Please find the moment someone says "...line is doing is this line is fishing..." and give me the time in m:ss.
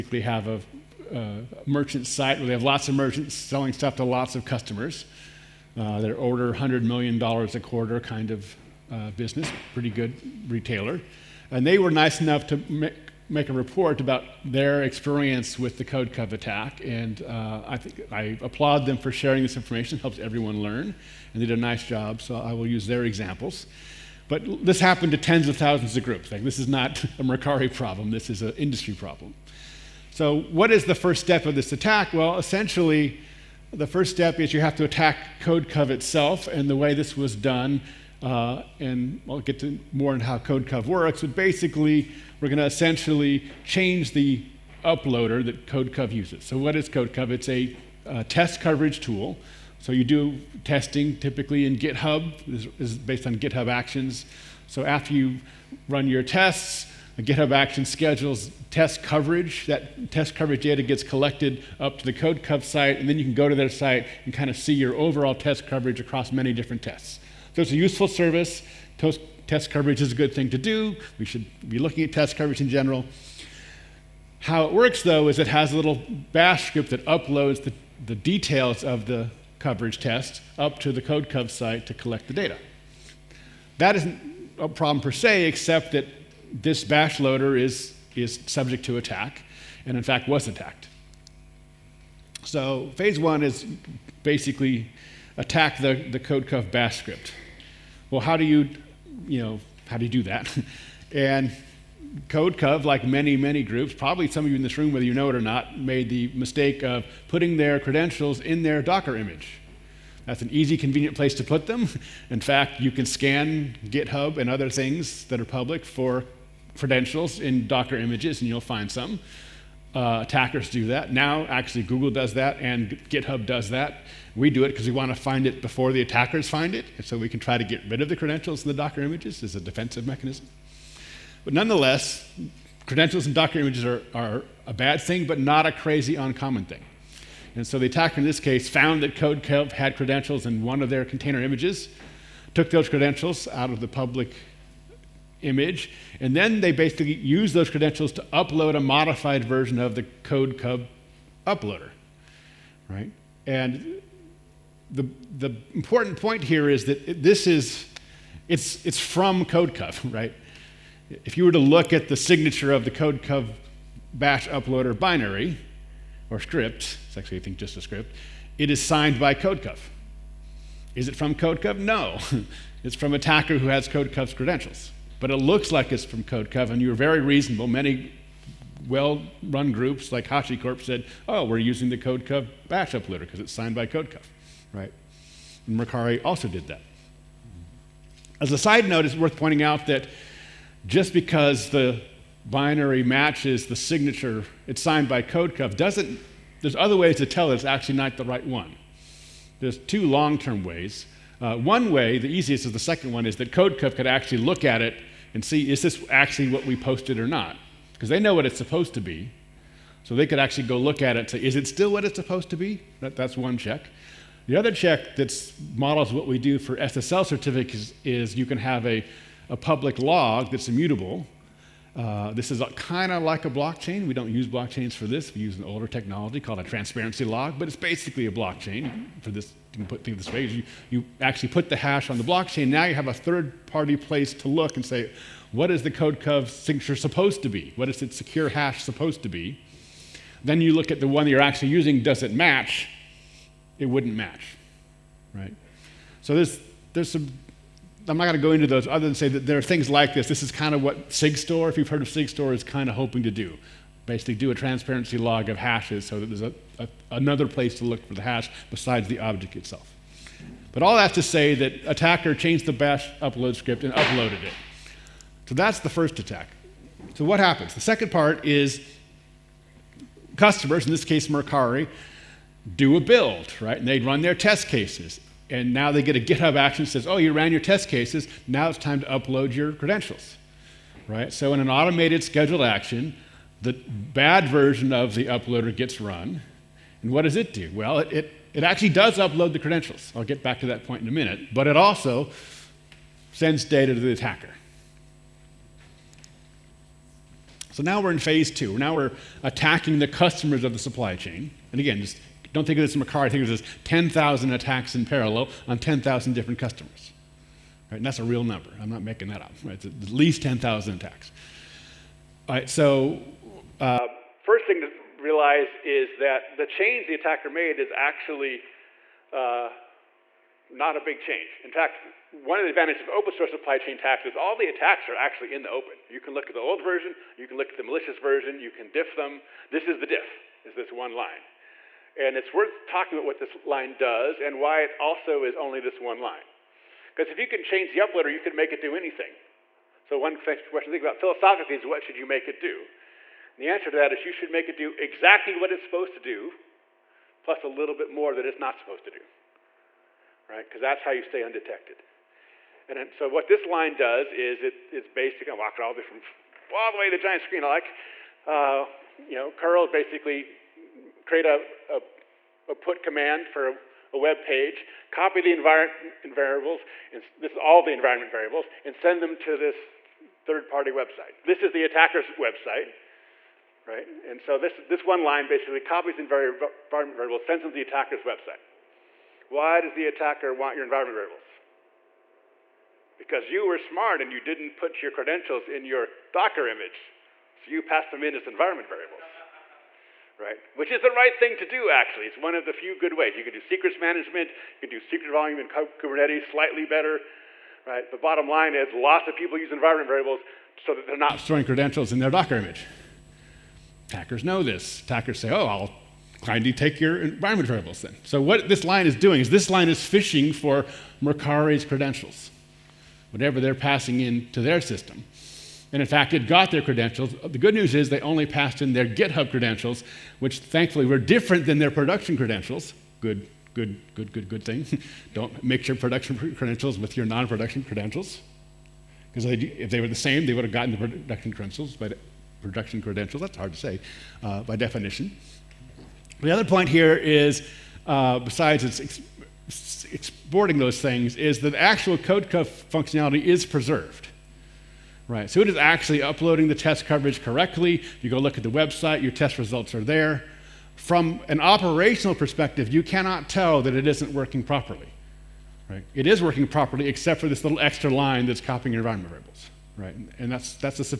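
6:48.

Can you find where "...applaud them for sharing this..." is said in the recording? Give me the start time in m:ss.
0:18.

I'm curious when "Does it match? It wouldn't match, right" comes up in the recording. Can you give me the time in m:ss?
4:02.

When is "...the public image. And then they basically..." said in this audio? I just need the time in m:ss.
2:23.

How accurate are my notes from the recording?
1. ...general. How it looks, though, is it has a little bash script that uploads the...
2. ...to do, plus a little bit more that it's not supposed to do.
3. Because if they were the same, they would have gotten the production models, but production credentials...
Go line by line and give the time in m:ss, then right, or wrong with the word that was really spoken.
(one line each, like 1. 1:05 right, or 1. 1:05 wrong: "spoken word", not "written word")
1. 1:12 wrong: "works", not "looks"
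2. 5:46 right
3. 7:09 wrong: "credentials", not "models".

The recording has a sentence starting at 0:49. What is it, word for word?
So, you do testing typically in GitHub, this is based on GitHub Actions.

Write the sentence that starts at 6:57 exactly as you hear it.
The good news is they only passed in their GitHub credentials, which thankfully were different than their production credentials.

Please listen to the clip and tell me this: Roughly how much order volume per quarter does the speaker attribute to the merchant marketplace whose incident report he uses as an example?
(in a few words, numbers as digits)
$100 million.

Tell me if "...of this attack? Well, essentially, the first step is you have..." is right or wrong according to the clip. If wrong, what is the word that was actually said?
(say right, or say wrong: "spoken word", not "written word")
right.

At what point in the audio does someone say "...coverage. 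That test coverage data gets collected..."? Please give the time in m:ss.
0:59.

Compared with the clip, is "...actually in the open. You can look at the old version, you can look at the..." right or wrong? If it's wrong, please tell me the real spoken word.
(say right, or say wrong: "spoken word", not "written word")
right.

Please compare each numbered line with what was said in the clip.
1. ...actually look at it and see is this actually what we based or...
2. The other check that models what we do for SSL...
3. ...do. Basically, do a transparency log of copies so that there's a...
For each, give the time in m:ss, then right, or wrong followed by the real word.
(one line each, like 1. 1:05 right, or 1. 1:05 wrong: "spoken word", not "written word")
1. 3:24 wrong: "posted", not "based"
2. 3:34 right
3. 4:13 wrong: "hashes", not "copies".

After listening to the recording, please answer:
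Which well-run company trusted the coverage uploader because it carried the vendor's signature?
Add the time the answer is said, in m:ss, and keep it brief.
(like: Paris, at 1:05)
HashiCorp, at 3:00.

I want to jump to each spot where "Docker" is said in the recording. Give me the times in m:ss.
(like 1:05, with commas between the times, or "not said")
1:48, 1:57, 2:08, 2:13, 6:26, 6:42.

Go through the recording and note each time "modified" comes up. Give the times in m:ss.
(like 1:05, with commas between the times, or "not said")
2:28.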